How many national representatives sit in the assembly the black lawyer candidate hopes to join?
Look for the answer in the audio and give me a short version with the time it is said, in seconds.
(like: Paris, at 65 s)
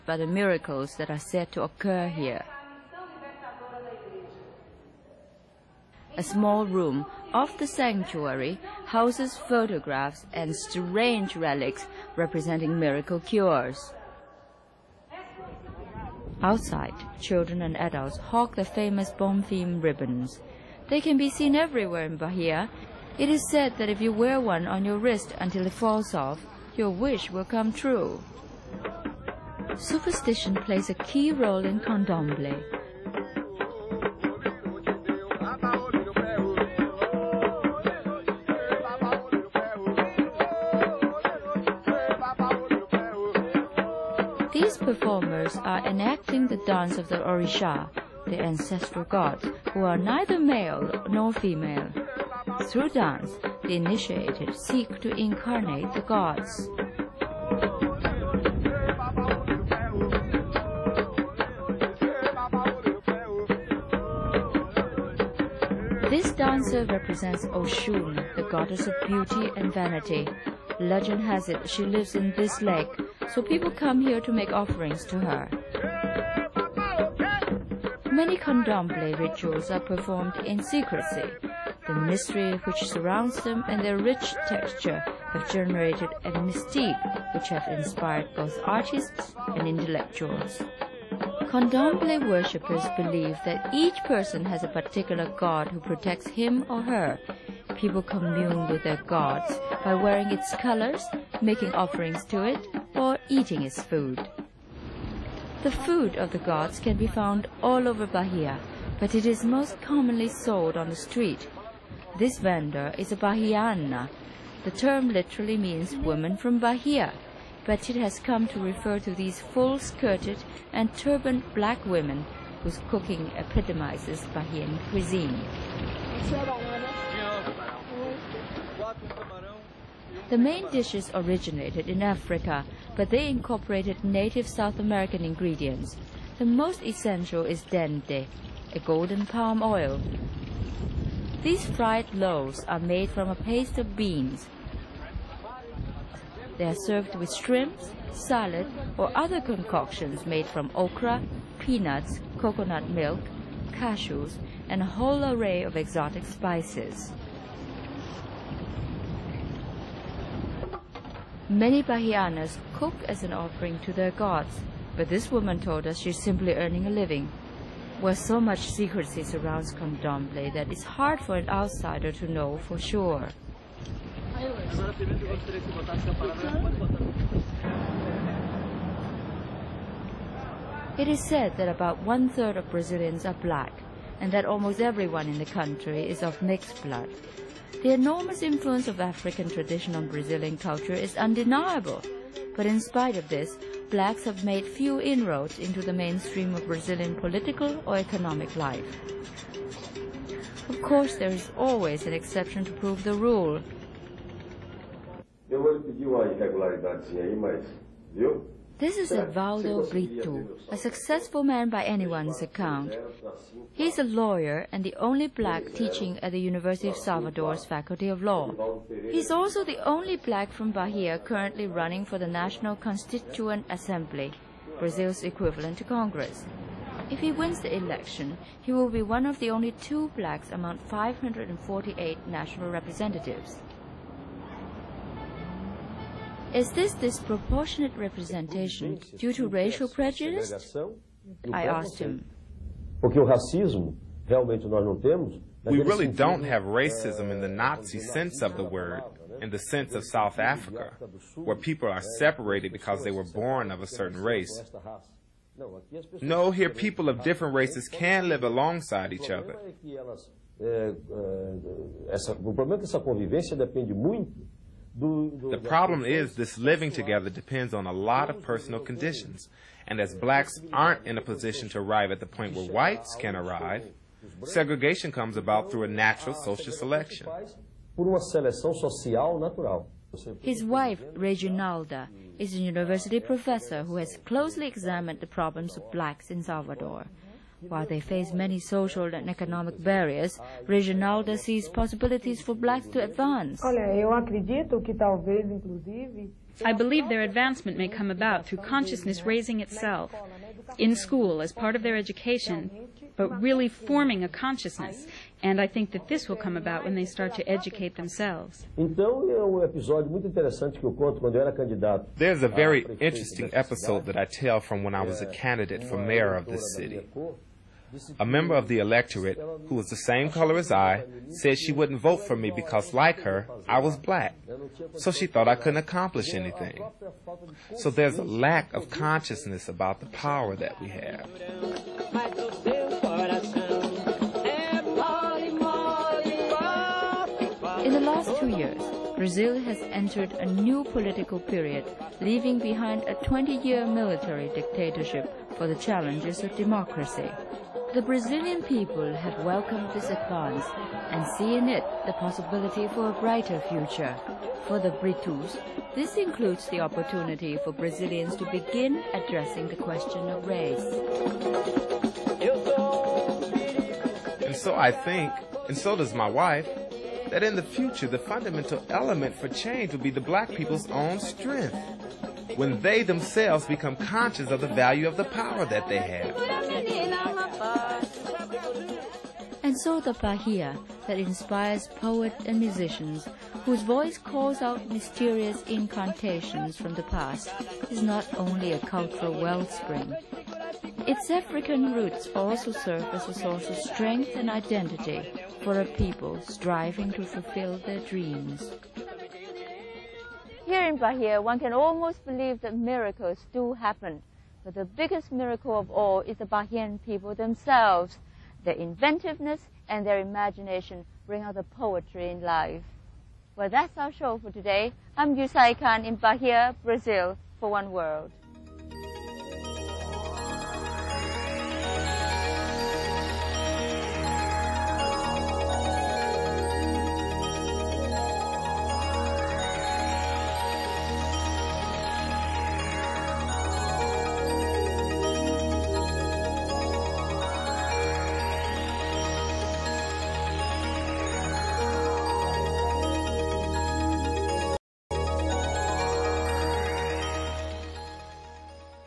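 548, at 230 s.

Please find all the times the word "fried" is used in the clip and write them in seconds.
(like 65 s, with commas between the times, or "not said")
141 s.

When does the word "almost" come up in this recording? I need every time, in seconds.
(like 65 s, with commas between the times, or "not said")
184 s, 401 s.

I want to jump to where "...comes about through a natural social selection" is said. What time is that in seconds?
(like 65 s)
275 s.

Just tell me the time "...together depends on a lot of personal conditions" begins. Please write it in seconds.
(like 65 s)
266 s.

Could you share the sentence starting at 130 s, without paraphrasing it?
The main dishes originated in Africa, but they incorporated native South American ingredients.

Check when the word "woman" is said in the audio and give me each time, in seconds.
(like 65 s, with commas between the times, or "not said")
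115 s, 165 s.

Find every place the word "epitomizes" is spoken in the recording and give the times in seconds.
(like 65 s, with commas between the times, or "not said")
123 s.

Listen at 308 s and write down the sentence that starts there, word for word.
Um There's a very interesting episode that I tell from when I was a candidate for mayor of this city.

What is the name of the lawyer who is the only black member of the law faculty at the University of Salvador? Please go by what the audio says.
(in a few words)
Edvaldo Brito.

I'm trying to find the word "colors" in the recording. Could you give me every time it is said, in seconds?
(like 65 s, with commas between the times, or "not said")
100 s, 320 s.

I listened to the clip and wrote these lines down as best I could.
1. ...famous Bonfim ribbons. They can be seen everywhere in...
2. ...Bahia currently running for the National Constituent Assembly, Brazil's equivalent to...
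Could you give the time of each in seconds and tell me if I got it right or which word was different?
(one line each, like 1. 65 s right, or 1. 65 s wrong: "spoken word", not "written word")
1. 18 s right
2. 220 s right.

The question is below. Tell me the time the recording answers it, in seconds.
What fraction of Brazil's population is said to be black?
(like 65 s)
182 s.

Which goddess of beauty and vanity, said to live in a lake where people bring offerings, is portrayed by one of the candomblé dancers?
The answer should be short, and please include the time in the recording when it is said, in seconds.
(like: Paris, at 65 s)
Oshun, at 67 s.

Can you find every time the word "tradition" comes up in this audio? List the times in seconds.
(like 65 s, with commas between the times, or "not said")
189 s.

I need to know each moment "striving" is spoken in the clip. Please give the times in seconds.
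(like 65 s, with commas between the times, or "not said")
396 s.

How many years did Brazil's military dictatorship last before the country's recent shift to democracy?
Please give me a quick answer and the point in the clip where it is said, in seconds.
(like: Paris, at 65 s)
20 years, at 343 s.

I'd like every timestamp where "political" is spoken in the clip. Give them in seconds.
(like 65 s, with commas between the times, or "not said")
197 s, 340 s.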